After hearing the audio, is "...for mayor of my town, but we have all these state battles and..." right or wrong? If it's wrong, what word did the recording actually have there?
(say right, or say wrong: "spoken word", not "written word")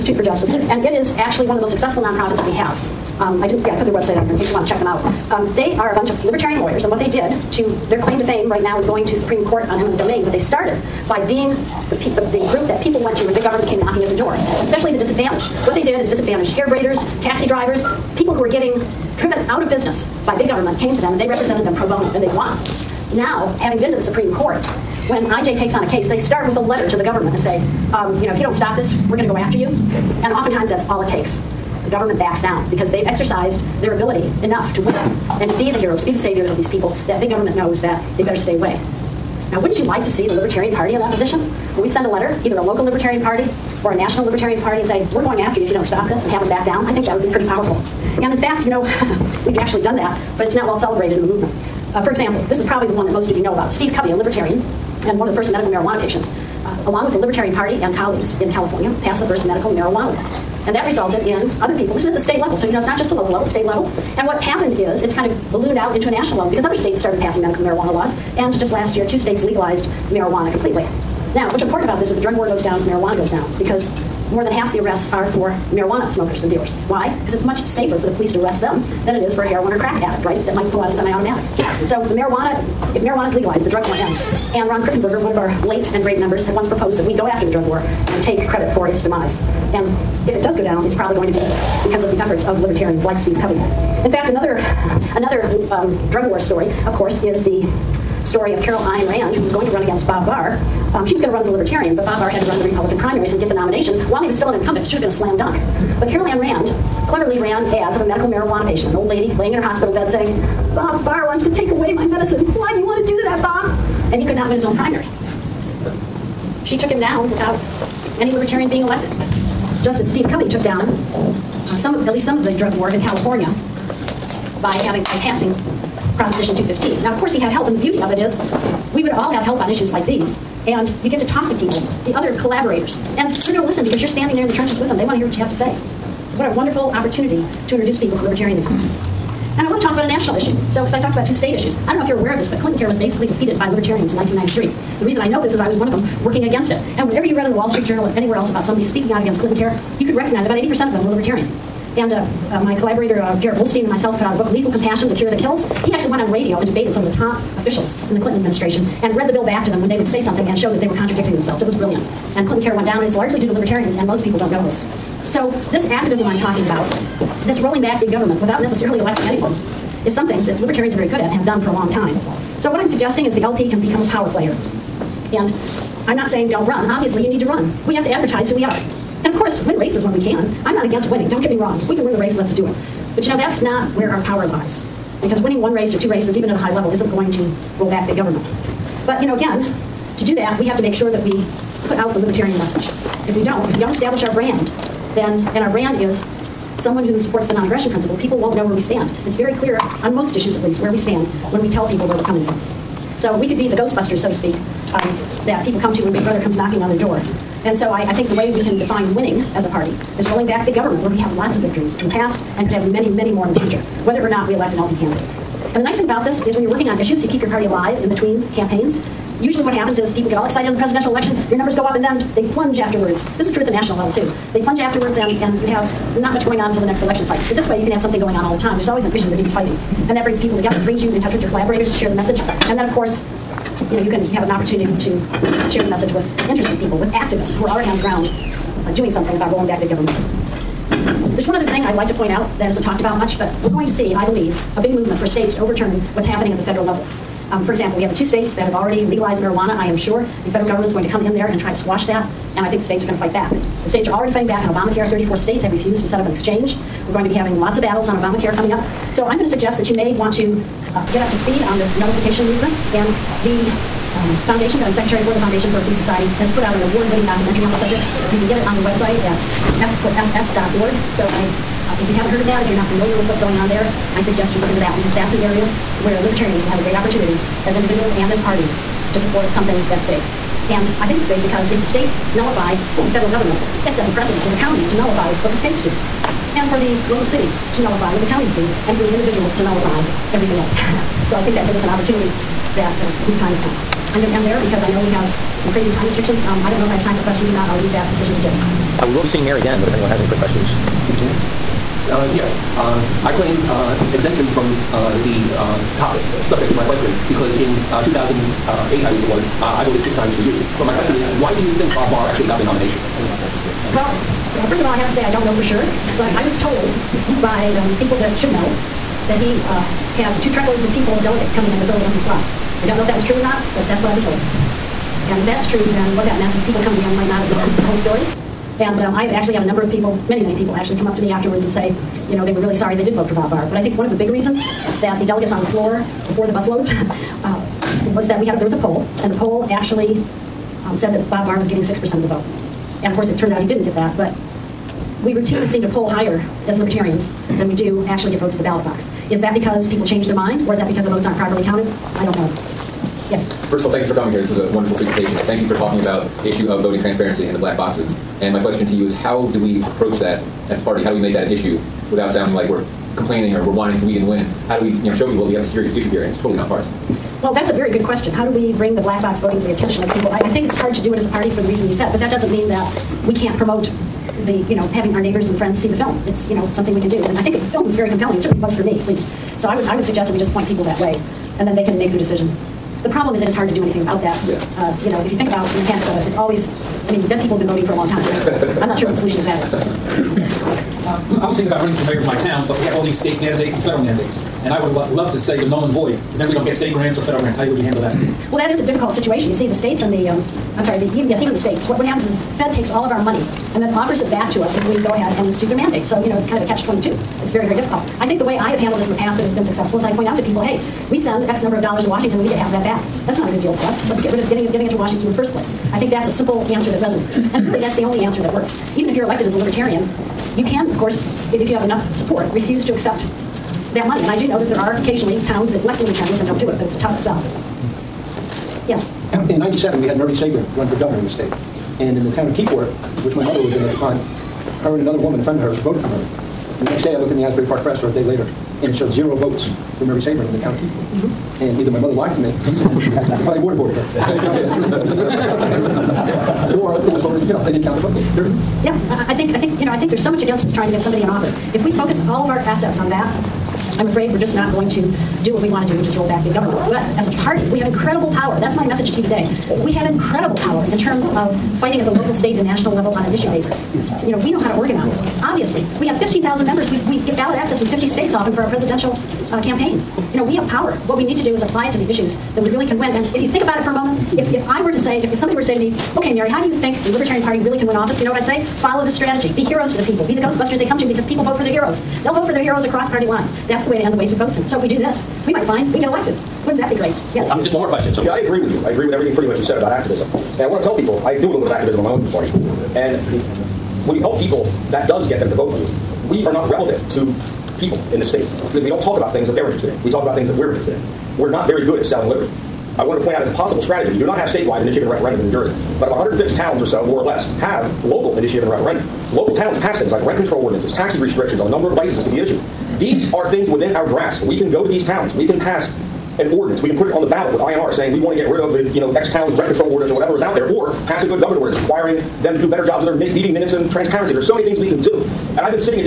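wrong: "mandates", not "battles".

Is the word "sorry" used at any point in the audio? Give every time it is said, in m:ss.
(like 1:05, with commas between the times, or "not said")
5:32, 6:40.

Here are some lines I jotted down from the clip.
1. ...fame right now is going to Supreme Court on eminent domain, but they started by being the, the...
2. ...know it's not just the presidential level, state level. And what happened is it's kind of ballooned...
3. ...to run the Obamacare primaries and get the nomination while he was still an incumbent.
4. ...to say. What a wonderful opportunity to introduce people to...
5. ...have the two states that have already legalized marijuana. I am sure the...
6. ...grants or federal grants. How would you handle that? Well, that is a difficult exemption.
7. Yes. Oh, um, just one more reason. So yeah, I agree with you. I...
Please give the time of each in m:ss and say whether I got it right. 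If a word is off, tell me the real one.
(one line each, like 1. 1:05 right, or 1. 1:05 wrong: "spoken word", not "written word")
1. 0:08 right
2. 1:02 wrong: "local", not "presidential"
3. 1:42 wrong: "Republican", not "Obamacare"
4. 2:15 right
5. 4:08 right
6. 6:36 wrong: "situation", not "exemption"
7. 8:07 wrong: "question", not "reason".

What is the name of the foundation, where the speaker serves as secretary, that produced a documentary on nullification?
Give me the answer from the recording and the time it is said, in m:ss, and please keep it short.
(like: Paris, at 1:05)
Foundation for a Free Society, at 4:25.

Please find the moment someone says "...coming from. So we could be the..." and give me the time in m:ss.
3:22.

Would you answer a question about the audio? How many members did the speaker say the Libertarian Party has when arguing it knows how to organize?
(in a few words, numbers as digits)
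15,000.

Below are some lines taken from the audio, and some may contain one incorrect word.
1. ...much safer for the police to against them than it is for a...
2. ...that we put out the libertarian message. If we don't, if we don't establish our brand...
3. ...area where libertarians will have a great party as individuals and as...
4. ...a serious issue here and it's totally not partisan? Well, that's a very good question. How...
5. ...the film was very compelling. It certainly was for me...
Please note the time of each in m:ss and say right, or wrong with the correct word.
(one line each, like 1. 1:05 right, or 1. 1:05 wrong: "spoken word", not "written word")
1. 1:17 wrong: "arrest", not "against"
2. 3:11 right
3. 4:35 wrong: "opportunity", not "party"
4. 6:05 right
5. 6:17 right.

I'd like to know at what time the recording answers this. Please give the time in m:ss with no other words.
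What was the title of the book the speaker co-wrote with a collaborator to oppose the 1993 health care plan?
2:34.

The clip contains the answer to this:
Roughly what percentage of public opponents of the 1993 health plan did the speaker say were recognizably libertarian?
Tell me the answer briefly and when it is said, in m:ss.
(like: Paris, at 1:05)
80%, at 2:30.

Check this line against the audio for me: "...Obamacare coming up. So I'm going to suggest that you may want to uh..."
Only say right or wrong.
right.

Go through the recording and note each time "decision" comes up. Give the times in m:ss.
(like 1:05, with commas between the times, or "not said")
4:58, 6:22.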